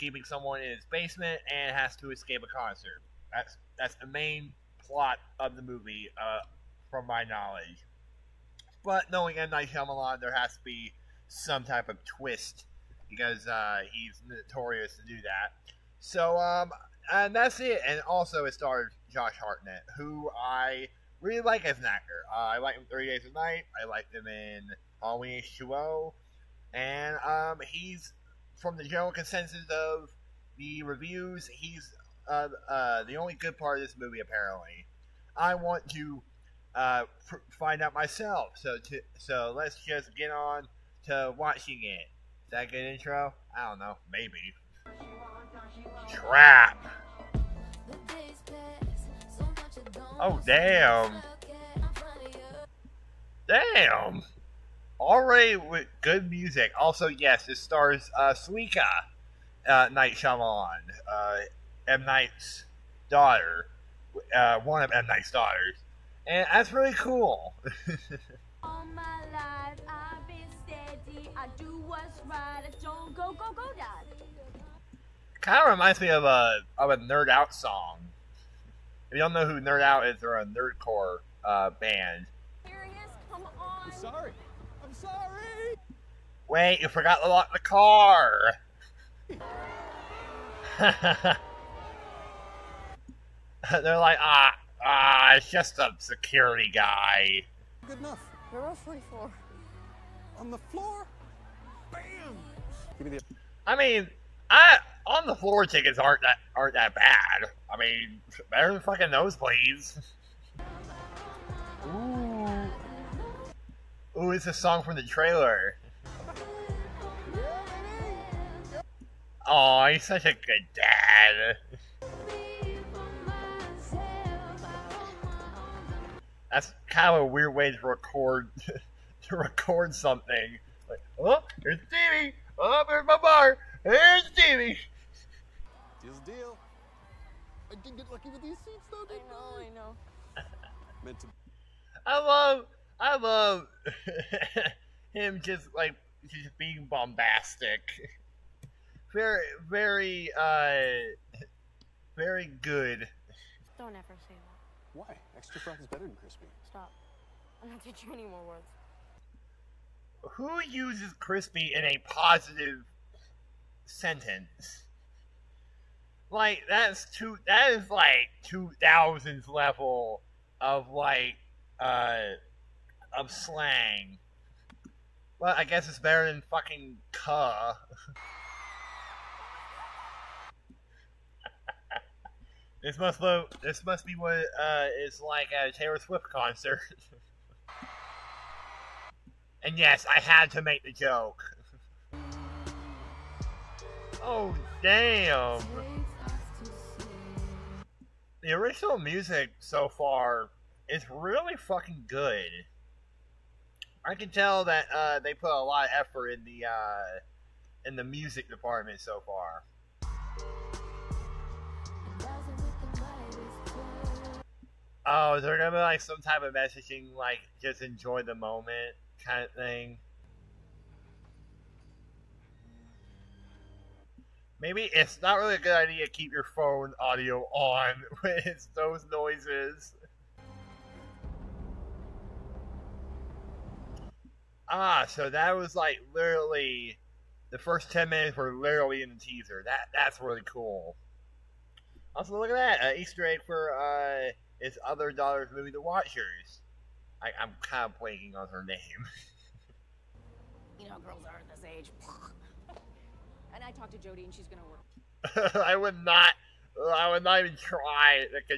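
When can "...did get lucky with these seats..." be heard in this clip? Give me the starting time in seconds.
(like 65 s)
137 s.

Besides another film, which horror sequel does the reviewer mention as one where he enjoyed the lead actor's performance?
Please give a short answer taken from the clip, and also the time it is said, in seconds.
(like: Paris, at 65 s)
Halloween H2O, at 25 s.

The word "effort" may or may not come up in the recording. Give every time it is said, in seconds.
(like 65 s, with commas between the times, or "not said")
205 s.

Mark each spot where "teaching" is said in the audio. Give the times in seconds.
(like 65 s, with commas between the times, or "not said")
157 s.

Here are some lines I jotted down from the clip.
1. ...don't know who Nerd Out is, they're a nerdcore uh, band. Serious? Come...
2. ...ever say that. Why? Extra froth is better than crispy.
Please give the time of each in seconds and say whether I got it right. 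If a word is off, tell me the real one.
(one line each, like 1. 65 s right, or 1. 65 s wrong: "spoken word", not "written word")
1. 79 s right
2. 153 s right.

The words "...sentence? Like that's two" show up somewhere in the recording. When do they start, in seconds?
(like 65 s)
163 s.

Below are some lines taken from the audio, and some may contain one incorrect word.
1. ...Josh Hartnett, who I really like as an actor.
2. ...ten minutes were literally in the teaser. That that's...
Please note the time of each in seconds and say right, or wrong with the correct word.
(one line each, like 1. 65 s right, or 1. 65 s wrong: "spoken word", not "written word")
1. 19 s right
2. 237 s right.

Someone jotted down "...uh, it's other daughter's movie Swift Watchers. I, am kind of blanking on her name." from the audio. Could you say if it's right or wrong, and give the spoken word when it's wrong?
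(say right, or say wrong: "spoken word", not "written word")
wrong: "The", not "Swift".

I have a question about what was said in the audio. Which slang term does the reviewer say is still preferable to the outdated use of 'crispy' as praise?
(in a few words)
cuh.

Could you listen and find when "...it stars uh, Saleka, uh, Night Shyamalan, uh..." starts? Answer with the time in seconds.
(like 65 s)
57 s.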